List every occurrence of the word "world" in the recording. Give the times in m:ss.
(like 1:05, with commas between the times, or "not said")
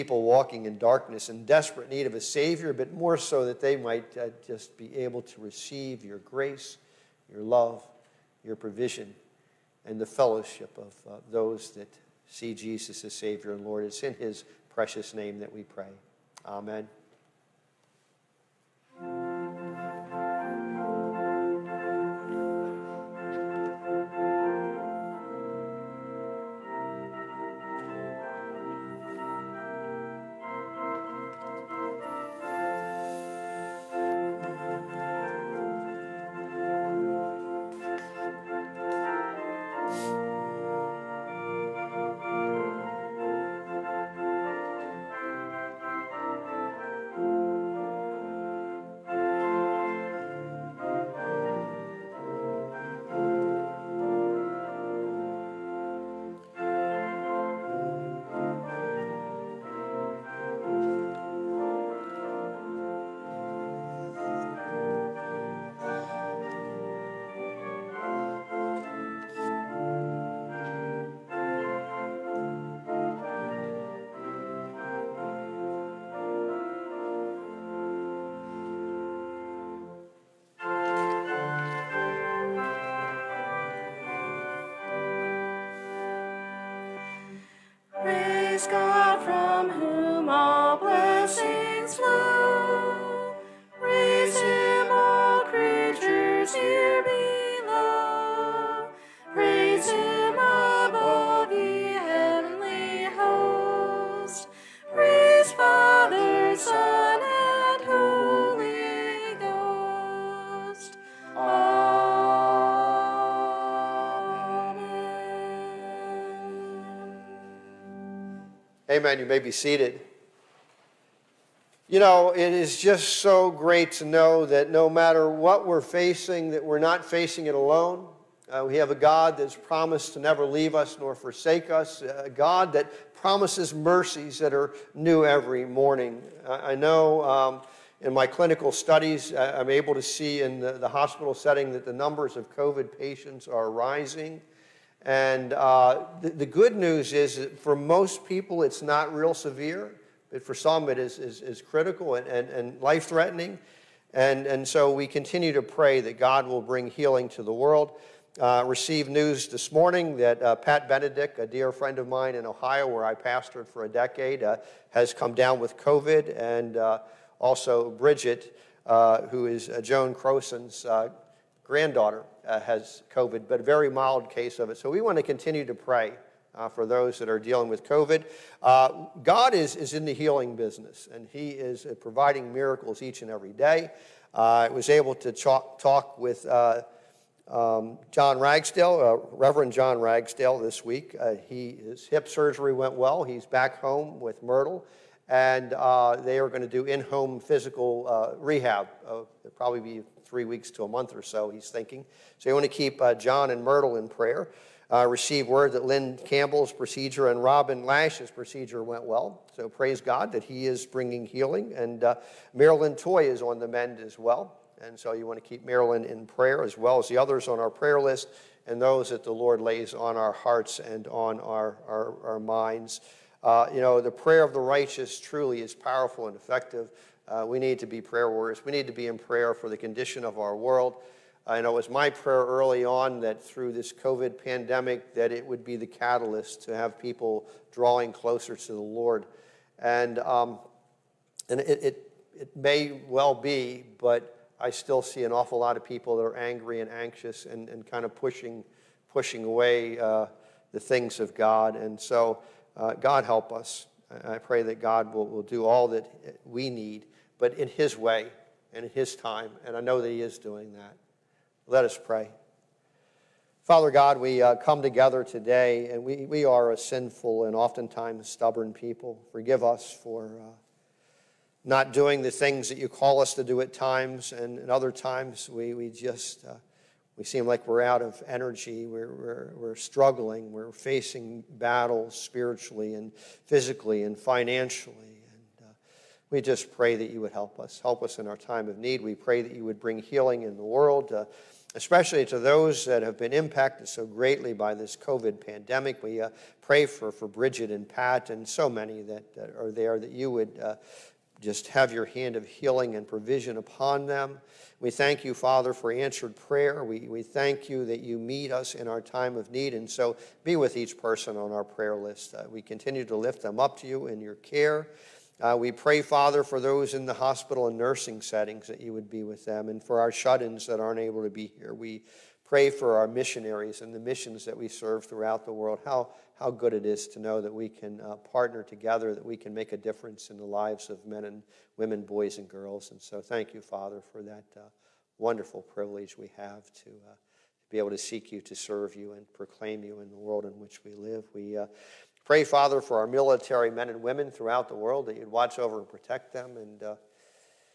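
2:37, 3:50, 4:50, 5:25, 5:40, 5:44.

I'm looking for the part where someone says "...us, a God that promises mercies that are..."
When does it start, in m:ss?
2:11.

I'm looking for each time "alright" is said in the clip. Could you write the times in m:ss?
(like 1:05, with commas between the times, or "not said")
not said.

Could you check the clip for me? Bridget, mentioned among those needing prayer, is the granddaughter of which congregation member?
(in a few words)
Joan Croson.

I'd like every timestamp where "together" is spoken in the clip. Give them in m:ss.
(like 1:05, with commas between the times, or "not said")
4:24, 5:28.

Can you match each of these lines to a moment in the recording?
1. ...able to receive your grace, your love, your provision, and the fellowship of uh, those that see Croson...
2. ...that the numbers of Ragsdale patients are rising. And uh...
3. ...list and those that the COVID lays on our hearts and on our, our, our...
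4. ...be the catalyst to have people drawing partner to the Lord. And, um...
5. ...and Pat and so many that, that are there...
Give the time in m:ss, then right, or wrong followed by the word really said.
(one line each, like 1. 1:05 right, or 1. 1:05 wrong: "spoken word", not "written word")
1. 0:04 wrong: "Jesus", not "Croson"
2. 2:21 wrong: "COVID", not "Ragsdale"
3. 3:37 wrong: "Lord", not "COVID"
4. 3:55 wrong: "closer", not "partner"
5. 4:57 right.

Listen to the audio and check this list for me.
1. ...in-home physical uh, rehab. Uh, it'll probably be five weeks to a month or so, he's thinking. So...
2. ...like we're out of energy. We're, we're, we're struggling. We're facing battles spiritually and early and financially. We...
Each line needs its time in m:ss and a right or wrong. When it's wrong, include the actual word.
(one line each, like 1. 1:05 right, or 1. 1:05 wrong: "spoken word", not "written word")
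1. 3:16 wrong: "three", not "five"
2. 4:37 wrong: "physically", not "early".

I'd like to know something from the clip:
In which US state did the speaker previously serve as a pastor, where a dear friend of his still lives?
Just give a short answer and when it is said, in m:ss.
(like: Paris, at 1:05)
Ohio, at 2:42.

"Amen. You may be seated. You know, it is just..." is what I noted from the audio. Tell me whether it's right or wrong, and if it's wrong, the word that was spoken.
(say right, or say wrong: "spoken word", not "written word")
right.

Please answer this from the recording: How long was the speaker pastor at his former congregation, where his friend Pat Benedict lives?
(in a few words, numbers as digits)
a decade.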